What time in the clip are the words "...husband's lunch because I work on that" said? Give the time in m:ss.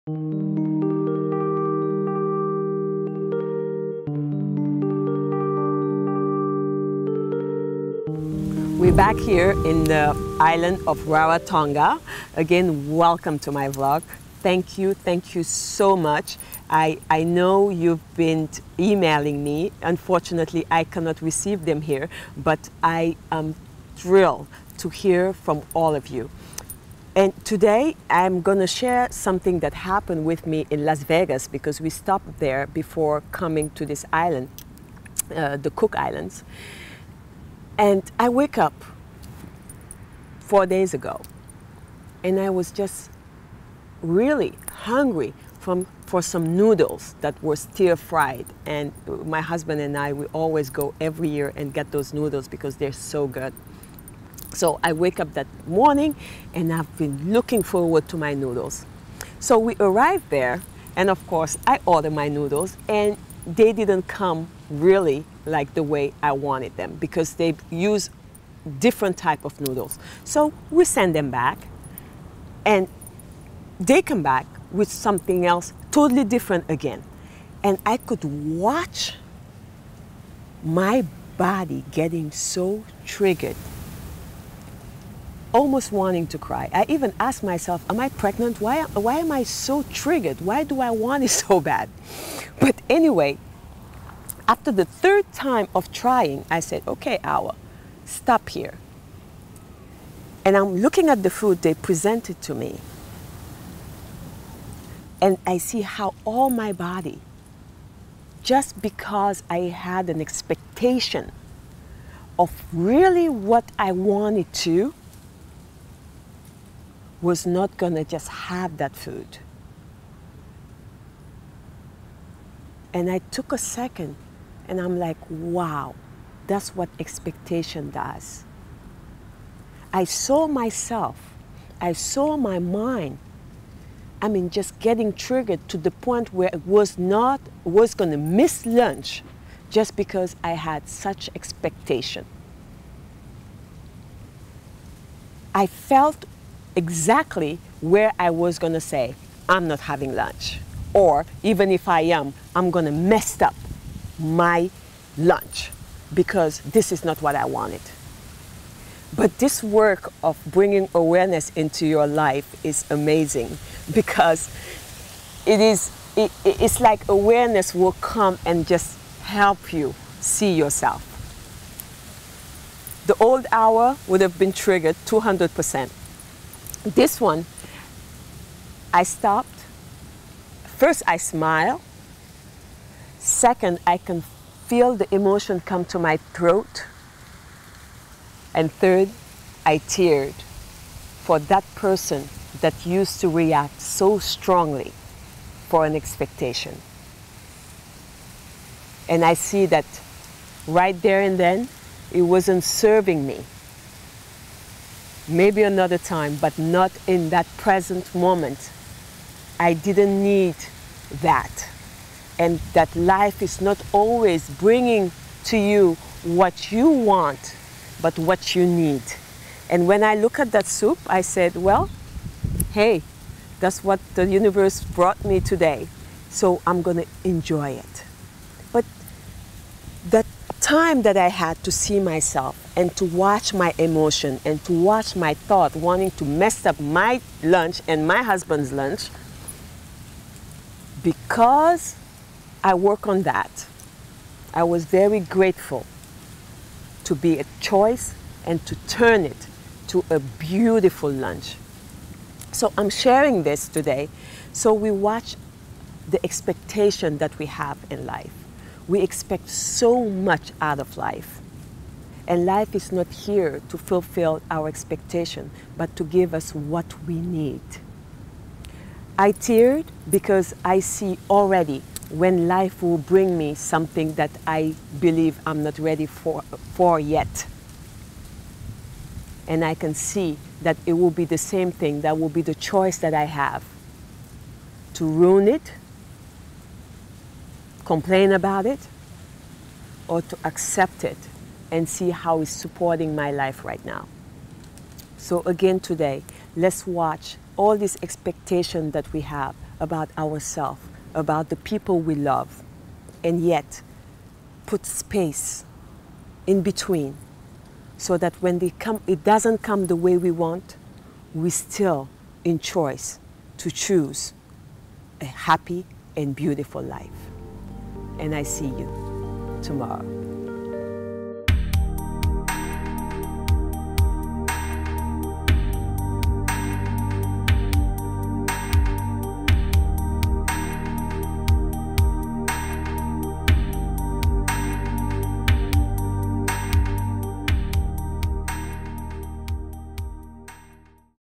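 3:58.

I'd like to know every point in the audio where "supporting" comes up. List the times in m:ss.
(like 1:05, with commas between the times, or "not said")
4:52.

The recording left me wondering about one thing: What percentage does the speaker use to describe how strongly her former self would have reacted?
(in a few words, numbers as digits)
200 percent.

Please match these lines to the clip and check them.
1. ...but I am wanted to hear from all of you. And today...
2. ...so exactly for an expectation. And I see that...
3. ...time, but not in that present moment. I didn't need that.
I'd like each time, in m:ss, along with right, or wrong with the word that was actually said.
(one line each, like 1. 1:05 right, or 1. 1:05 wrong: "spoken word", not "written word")
1. 0:22 wrong: "thrilled", not "wanted"
2. 3:13 wrong: "strongly", not "exactly"
3. 3:25 right.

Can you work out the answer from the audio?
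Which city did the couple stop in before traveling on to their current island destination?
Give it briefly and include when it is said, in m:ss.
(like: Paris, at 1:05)
Las Vegas, at 0:30.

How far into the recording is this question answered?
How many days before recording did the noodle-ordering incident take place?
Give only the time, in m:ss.
0:40.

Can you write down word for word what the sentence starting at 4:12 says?
So I'm sharing this today so we watch the expectation that we have in life.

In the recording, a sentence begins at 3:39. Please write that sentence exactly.
And when I look at that soup, I said, well, hey, that's what the universe brought me today.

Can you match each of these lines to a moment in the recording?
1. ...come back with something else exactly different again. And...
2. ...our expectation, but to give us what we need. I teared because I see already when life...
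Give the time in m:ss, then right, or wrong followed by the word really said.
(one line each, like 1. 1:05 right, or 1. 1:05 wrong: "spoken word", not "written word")
1. 1:14 wrong: "totally", not "exactly"
2. 4:24 right.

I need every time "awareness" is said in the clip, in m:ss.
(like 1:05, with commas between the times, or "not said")
2:40, 2:47.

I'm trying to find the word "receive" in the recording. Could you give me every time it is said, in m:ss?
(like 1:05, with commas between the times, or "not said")
0:21.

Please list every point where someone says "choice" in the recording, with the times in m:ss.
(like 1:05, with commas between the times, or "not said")
4:07, 4:42, 5:12.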